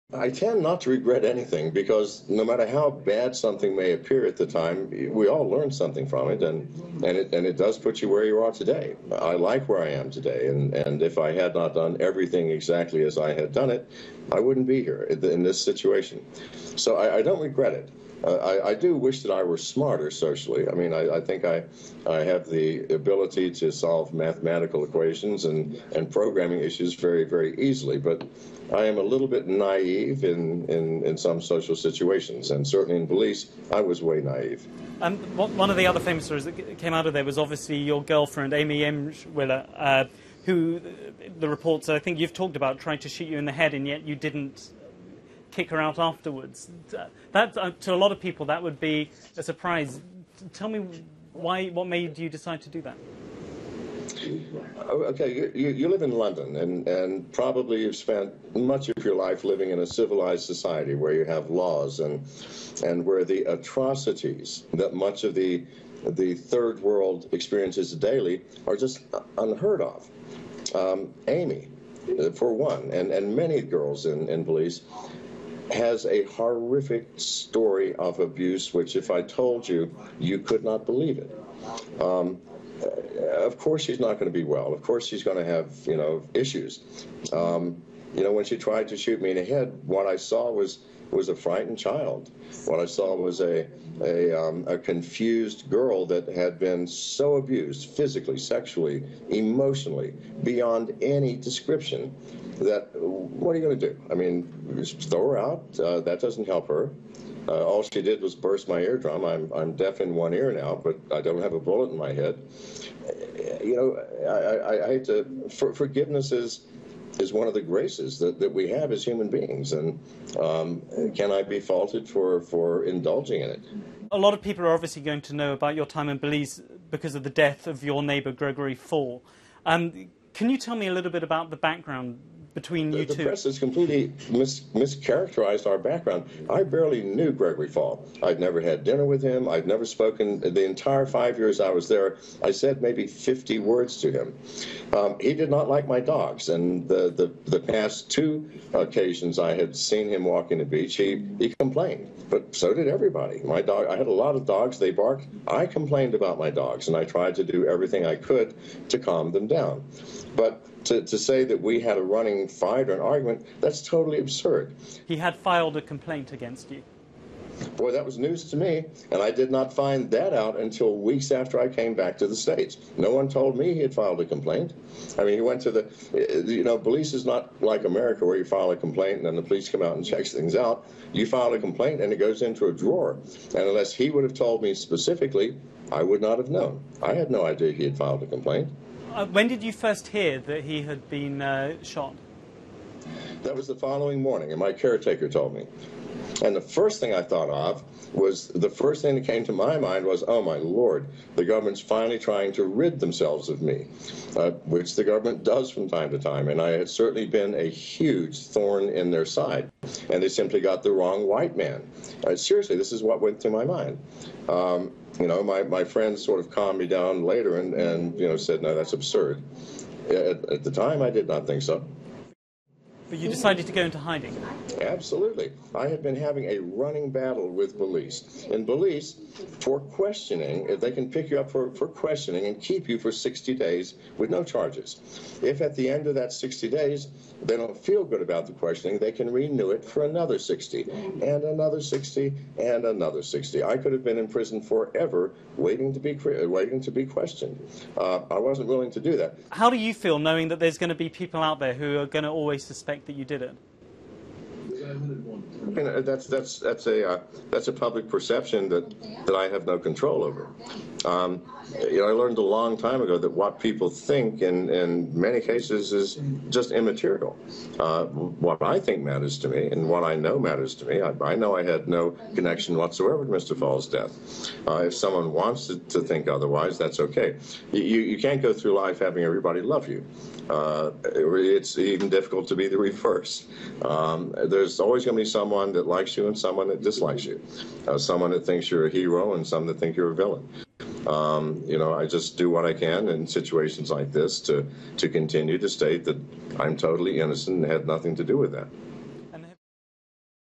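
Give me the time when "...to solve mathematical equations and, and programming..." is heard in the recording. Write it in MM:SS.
00:23.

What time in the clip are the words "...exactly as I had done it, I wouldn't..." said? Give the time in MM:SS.
00:12.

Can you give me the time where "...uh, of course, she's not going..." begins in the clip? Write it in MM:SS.
01:22.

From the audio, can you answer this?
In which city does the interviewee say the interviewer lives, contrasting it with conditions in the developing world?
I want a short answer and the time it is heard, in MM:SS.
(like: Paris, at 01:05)
London, at 00:56.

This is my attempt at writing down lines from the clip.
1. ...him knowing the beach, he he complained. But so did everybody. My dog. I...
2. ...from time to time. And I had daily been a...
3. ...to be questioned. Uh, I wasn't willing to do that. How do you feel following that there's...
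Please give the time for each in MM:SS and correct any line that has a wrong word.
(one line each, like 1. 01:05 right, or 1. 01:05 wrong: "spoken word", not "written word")
1. 02:30 wrong: "walking", not "knowing"
2. 03:25 wrong: "certainly", not "daily"
3. 04:06 wrong: "knowing", not "following".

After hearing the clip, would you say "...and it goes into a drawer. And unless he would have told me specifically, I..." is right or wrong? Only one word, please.
right.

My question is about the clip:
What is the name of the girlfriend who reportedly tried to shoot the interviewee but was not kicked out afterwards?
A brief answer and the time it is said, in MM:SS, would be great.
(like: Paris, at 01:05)
Amy Emshwiller, at 00:38.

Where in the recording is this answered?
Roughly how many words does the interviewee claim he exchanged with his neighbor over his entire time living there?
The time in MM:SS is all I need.
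02:23.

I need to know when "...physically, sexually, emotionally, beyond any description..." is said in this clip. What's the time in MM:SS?
01:37.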